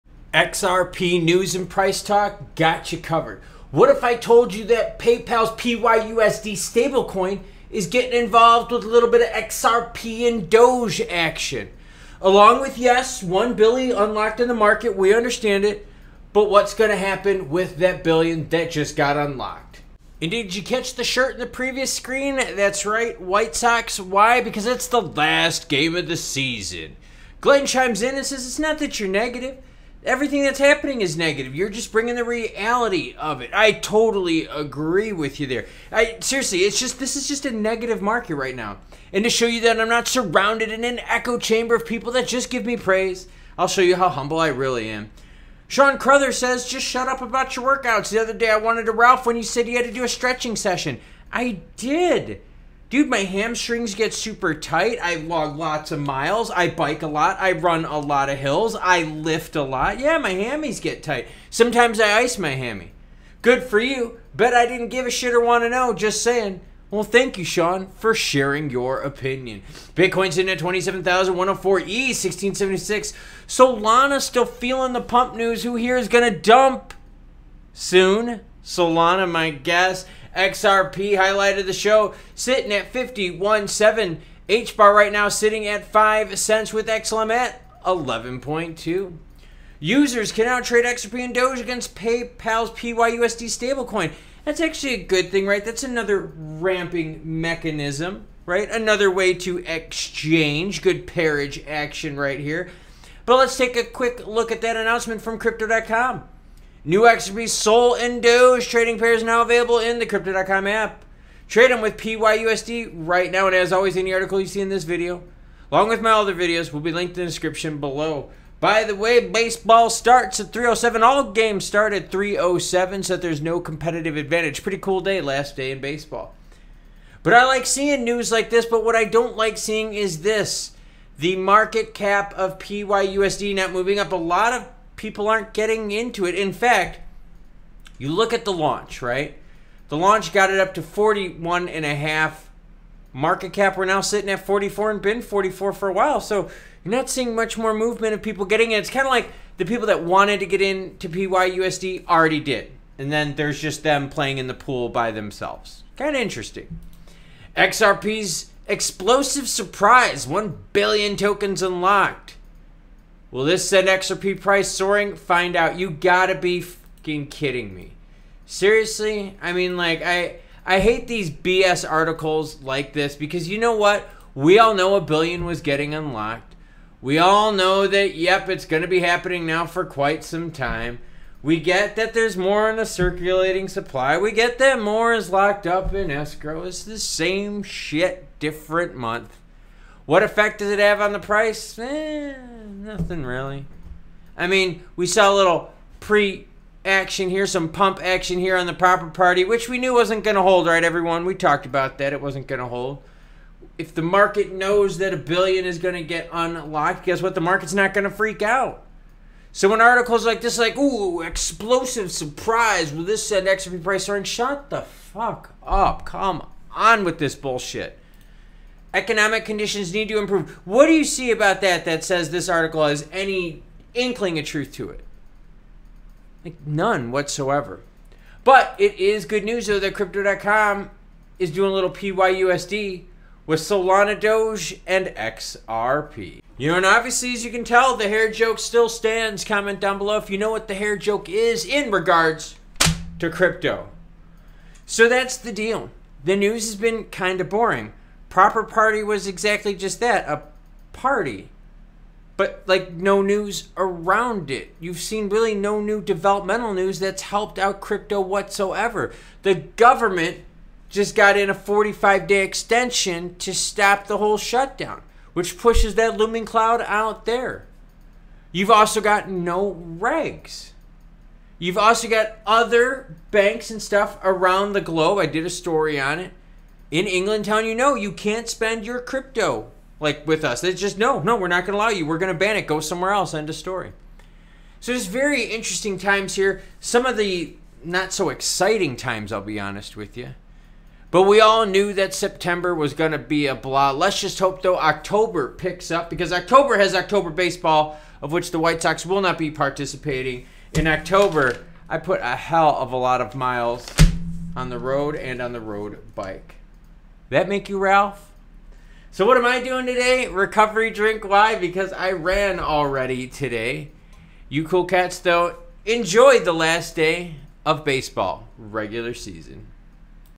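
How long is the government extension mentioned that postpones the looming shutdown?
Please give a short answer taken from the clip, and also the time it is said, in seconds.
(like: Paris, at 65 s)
45 days, at 261 s.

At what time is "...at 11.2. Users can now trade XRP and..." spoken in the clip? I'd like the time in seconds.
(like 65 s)
87 s.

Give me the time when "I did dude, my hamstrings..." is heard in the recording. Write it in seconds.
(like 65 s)
51 s.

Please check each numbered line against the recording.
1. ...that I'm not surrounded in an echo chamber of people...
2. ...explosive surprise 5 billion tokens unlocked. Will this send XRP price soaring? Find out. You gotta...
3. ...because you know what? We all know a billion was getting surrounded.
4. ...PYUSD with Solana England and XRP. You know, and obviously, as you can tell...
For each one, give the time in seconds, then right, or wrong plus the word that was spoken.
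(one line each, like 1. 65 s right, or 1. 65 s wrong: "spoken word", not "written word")
1. 39 s right
2. 158 s wrong: "1", not "5"
3. 173 s wrong: "unlocked", not "surrounded"
4. 231 s wrong: "Doge", not "England".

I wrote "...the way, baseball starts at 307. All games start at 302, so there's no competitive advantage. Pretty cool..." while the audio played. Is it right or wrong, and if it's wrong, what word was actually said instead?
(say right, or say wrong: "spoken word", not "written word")
wrong: "307", not "302".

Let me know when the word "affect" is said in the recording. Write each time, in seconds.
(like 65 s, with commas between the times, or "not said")
not said.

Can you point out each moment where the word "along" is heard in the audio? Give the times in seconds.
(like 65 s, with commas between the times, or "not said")
12 s, 115 s.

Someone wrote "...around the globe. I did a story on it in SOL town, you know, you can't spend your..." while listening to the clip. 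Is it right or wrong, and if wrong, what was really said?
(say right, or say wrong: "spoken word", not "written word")
wrong: "England", not "SOL".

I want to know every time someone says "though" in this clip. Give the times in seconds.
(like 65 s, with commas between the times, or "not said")
229 s, 294 s, 315 s.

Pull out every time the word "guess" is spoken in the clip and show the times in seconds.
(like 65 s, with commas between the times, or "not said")
79 s, 207 s.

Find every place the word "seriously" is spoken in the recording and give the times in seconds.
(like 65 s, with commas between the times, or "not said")
36 s, 168 s.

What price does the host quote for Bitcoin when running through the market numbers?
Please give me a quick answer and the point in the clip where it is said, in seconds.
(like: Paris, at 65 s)
27,104, at 70 s.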